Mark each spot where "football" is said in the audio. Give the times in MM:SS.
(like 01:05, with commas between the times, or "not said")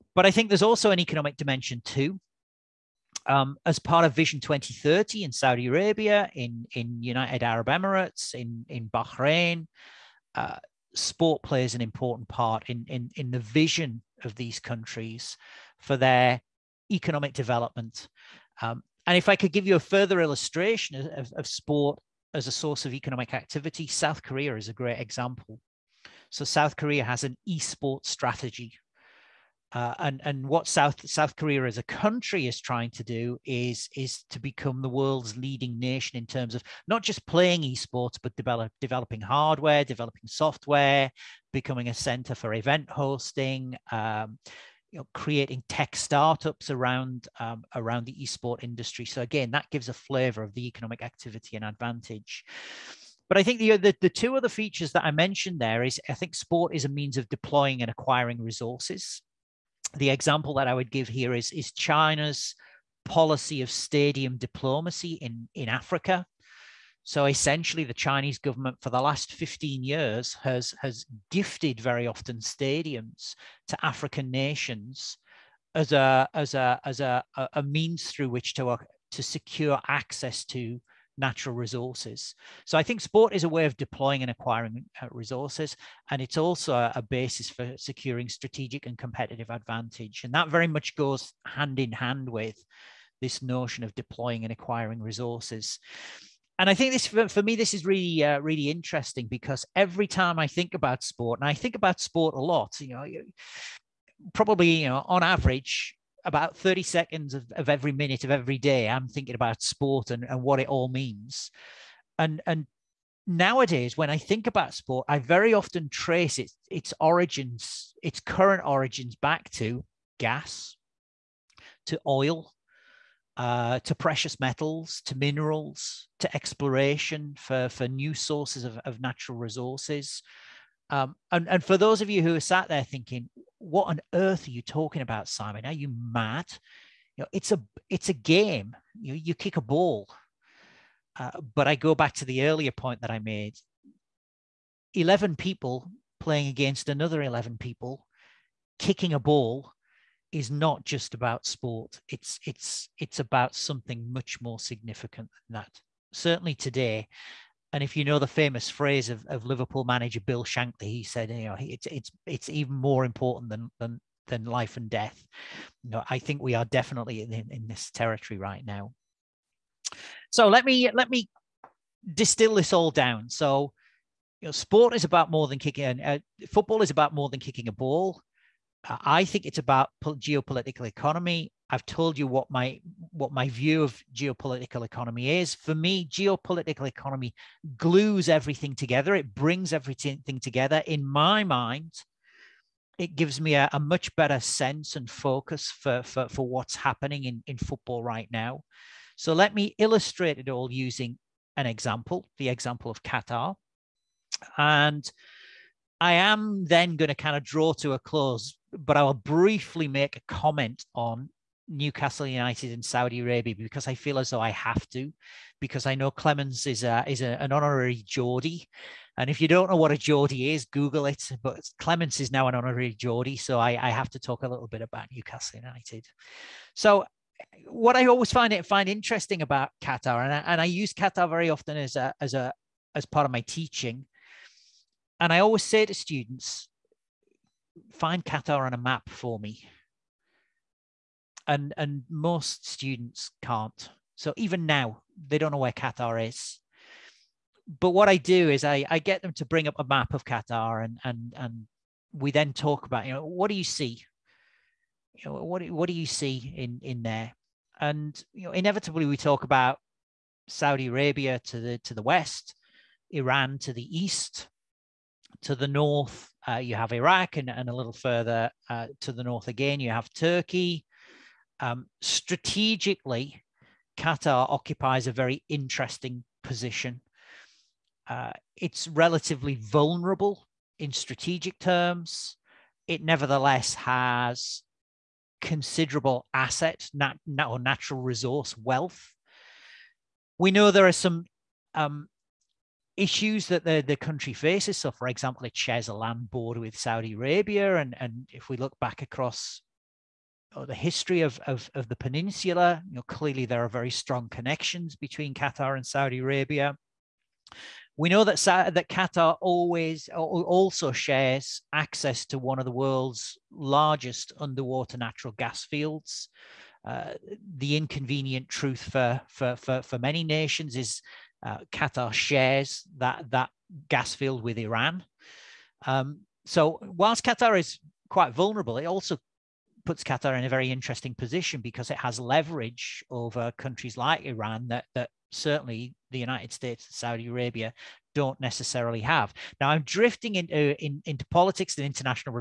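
02:56, 03:17.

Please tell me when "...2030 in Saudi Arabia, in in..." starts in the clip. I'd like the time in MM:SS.
00:04.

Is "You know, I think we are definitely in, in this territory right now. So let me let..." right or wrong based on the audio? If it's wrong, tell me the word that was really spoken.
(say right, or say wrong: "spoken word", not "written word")
right.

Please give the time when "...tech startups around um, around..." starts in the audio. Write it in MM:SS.
00:45.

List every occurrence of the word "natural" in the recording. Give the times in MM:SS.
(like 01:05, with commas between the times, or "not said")
01:21, 02:09, 04:47, 05:14.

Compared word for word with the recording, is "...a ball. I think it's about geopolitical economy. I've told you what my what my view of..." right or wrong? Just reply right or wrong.
right.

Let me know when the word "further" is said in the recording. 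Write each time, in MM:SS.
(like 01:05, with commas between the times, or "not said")
00:19, 04:27.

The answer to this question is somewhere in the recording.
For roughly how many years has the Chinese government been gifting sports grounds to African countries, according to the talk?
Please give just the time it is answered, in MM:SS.
01:09.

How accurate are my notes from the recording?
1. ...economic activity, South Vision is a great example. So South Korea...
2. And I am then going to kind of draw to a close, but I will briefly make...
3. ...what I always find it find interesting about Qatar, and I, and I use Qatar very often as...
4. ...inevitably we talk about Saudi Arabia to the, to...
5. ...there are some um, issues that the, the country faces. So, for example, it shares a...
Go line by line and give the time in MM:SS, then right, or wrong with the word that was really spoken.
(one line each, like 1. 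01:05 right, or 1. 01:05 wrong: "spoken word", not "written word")
1. 00:22 wrong: "Korea", not "Vision"
2. 03:24 right
3. 03:47 right
4. 04:18 right
5. 04:50 right.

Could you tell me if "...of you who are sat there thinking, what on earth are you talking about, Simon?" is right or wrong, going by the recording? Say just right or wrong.
right.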